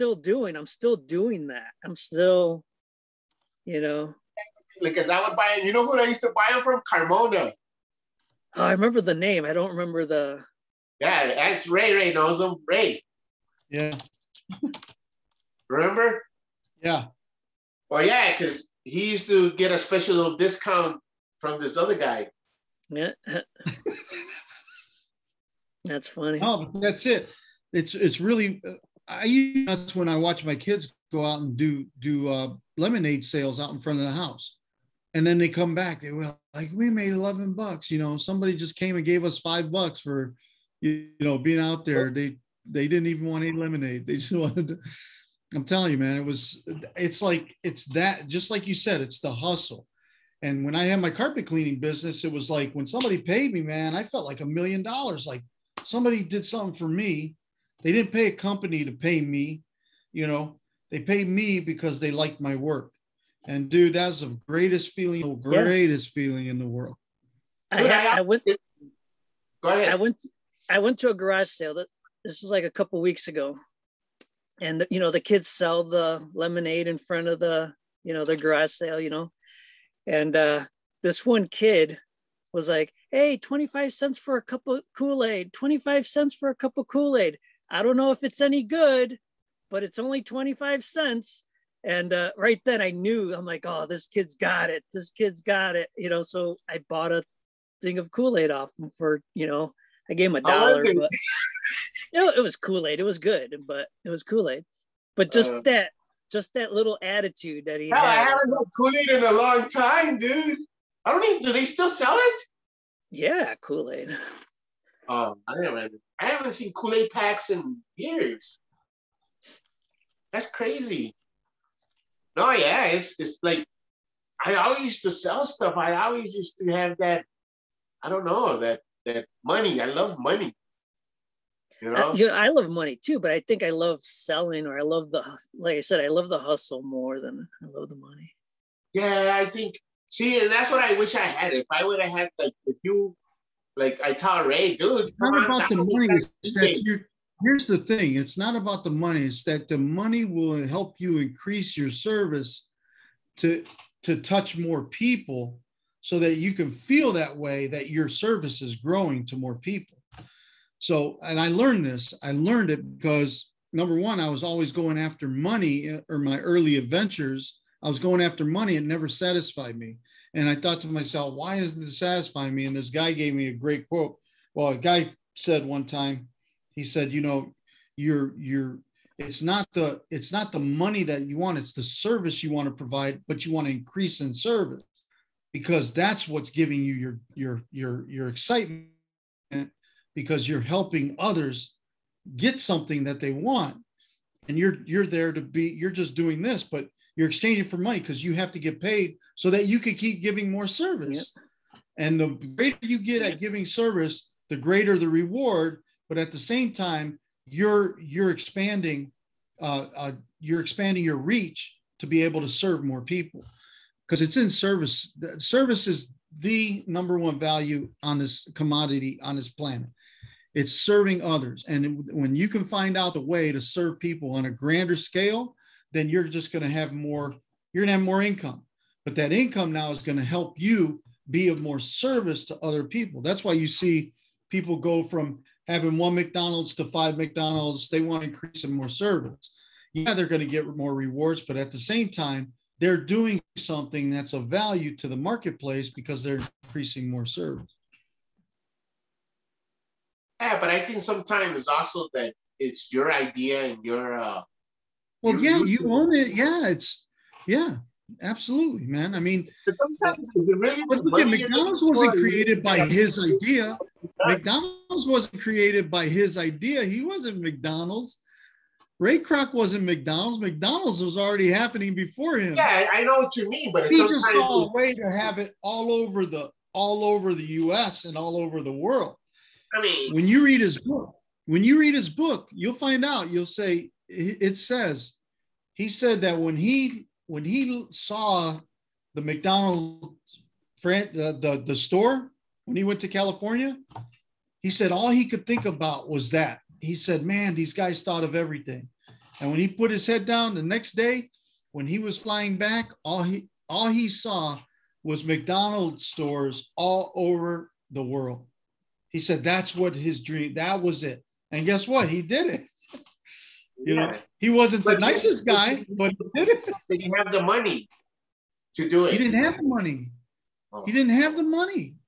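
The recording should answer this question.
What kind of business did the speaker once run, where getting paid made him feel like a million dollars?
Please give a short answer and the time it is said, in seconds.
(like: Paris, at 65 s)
carpet cleaning, at 51 s.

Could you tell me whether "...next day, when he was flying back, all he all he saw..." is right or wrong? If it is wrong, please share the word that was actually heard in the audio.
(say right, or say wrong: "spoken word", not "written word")
right.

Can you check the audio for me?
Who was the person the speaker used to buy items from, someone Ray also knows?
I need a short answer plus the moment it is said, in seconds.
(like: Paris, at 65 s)
Carmona, at 6 s.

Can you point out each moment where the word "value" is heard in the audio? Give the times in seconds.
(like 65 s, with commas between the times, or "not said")
217 s, 244 s.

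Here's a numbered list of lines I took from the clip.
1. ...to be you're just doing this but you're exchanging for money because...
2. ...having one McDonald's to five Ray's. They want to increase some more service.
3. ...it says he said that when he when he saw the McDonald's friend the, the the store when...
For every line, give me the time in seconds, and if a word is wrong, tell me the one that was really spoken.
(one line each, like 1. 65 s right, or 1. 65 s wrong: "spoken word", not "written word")
1. 195 s right
2. 235 s wrong: "McDonald", not "Ray"
3. 284 s right.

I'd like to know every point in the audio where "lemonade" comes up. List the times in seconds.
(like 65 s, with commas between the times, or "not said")
32 s, 43 s, 76 s.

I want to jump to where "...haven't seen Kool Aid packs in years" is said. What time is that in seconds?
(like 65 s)
116 s.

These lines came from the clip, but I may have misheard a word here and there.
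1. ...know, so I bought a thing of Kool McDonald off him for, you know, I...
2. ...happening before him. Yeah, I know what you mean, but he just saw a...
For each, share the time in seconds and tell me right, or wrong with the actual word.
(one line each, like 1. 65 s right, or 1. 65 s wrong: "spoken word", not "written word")
1. 96 s wrong: "Aid", not "McDonald"
2. 271 s right.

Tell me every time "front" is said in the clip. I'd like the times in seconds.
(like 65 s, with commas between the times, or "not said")
33 s, 76 s.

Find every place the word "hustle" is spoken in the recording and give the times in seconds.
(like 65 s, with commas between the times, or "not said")
49 s, 136 s.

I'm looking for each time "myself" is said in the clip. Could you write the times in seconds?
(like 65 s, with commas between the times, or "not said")
170 s.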